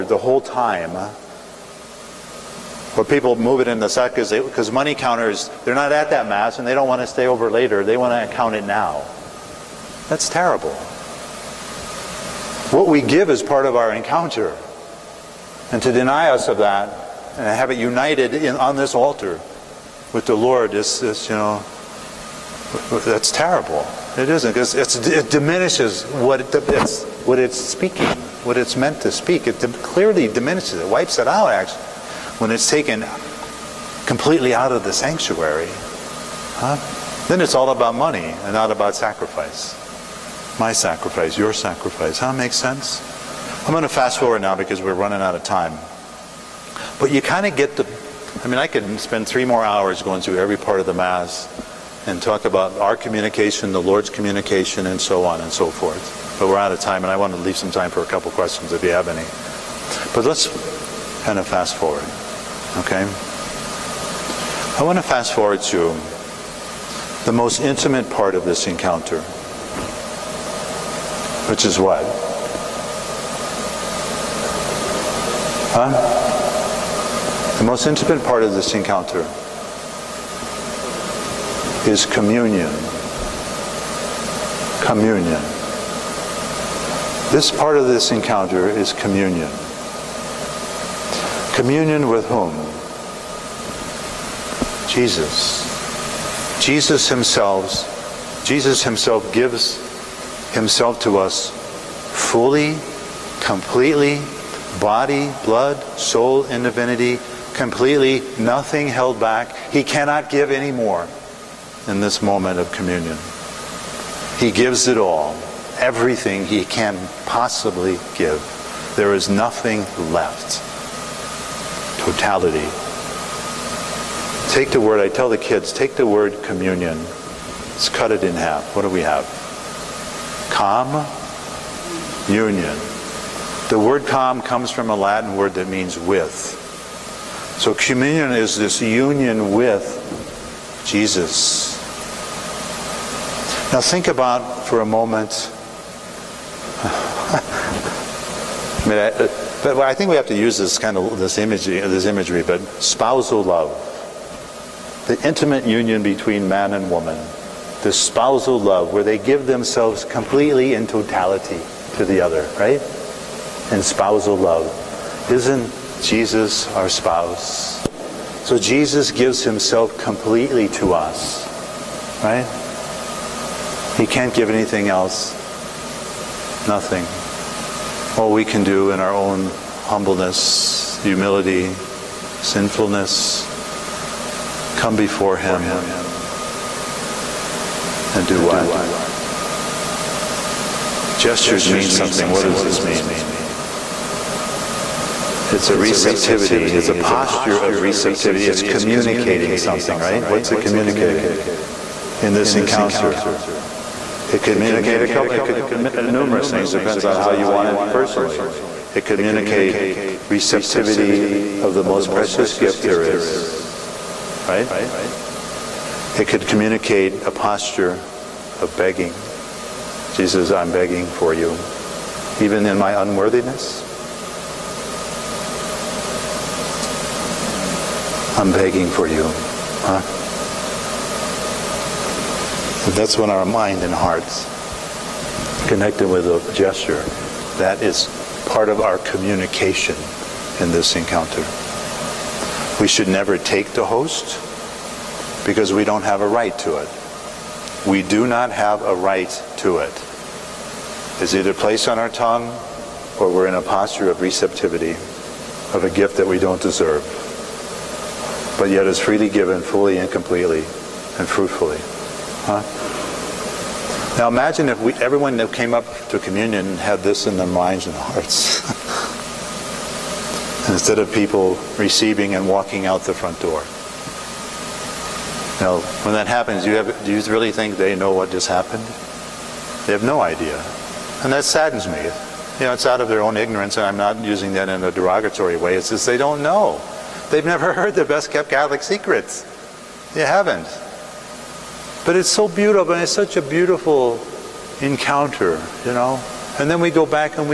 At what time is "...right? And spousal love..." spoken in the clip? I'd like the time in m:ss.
2:42.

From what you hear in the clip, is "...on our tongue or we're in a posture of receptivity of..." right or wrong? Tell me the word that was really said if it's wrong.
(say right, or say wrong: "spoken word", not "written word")
right.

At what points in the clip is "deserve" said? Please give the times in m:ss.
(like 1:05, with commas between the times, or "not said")
4:16.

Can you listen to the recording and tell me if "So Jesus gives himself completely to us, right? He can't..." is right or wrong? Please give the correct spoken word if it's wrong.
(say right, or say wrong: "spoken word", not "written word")
right.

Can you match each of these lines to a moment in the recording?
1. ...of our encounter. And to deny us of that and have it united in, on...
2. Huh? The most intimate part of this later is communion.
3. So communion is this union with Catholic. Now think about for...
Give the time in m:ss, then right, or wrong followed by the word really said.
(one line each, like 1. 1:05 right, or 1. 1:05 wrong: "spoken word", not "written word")
1. 0:13 right
2. 1:15 wrong: "encounter", not "later"
3. 2:17 wrong: "Jesus", not "Catholic".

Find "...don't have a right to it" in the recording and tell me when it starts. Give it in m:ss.
4:05.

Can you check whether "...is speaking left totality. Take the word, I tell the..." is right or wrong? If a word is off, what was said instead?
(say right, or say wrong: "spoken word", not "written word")
wrong: "nothing", not "speaking".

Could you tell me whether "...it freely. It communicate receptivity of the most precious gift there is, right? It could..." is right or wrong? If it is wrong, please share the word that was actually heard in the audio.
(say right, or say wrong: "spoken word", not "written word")
wrong: "personally", not "freely".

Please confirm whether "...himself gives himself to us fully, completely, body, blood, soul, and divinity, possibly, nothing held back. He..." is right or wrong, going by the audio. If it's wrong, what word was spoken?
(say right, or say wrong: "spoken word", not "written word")
wrong: "completely", not "possibly".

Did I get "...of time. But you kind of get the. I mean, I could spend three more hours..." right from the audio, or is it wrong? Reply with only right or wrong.
right.